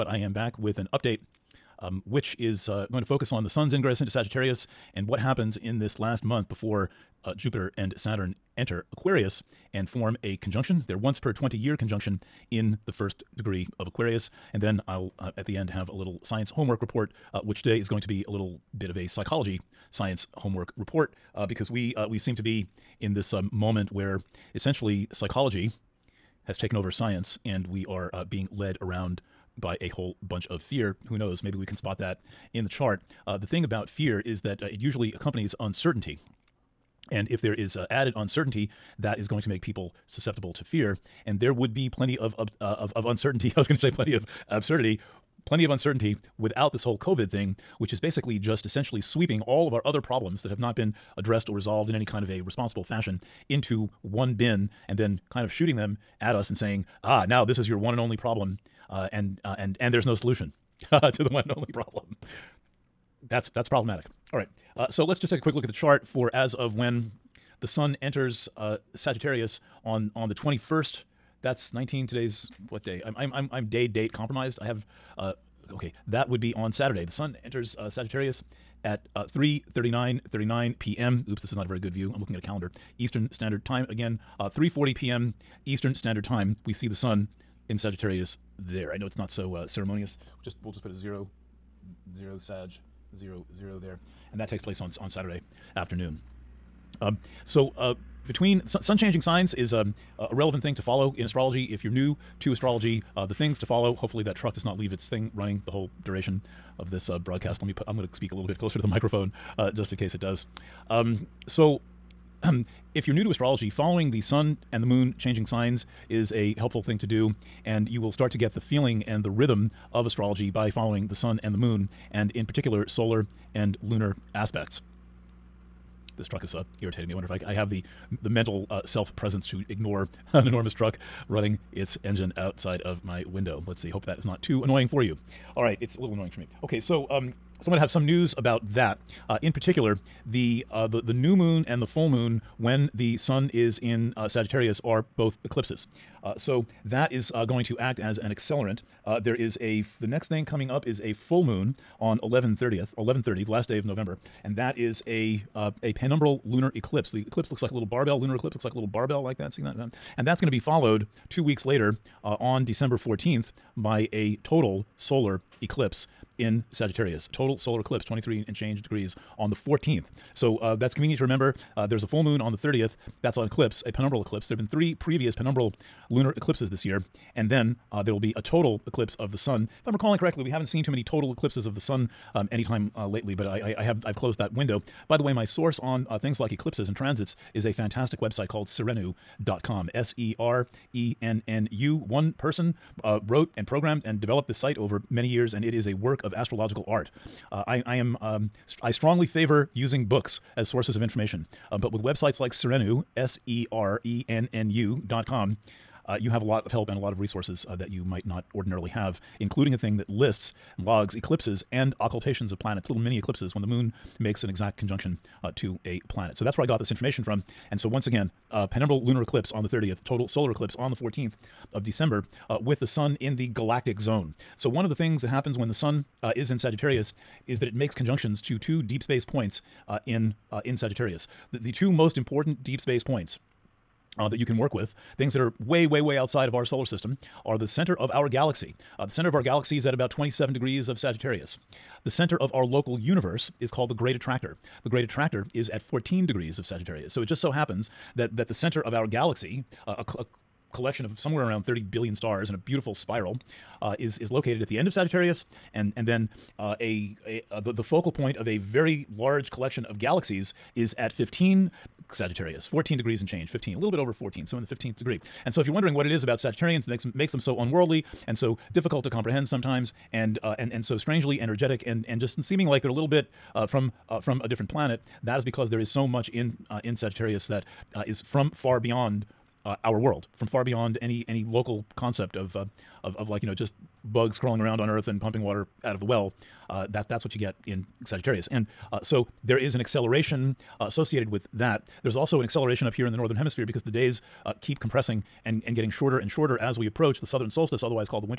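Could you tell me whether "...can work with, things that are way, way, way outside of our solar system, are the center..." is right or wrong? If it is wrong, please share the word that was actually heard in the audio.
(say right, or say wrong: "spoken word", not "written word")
right.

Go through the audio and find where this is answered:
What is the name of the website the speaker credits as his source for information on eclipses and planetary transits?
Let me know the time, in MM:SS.
03:08.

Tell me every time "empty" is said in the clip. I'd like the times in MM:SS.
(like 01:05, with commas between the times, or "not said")
not said.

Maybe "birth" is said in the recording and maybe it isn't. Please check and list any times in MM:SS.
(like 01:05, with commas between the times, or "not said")
not said.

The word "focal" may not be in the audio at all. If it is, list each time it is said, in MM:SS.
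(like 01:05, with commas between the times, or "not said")
04:17.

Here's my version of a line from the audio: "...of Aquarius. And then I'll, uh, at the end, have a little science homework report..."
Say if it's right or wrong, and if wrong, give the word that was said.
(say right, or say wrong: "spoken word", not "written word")
right.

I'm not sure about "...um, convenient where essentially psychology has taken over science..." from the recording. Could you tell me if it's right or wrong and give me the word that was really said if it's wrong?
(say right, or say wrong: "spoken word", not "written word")
wrong: "moment", not "convenient".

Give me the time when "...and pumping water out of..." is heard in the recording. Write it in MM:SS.
04:45.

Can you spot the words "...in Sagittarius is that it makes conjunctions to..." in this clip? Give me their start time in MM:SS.
03:46.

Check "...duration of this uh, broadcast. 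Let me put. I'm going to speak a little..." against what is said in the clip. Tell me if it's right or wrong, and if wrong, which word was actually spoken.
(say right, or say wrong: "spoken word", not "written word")
right.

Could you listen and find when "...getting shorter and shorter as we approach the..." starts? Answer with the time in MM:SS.
04:55.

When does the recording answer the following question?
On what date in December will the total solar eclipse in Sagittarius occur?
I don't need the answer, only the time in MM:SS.
02:42.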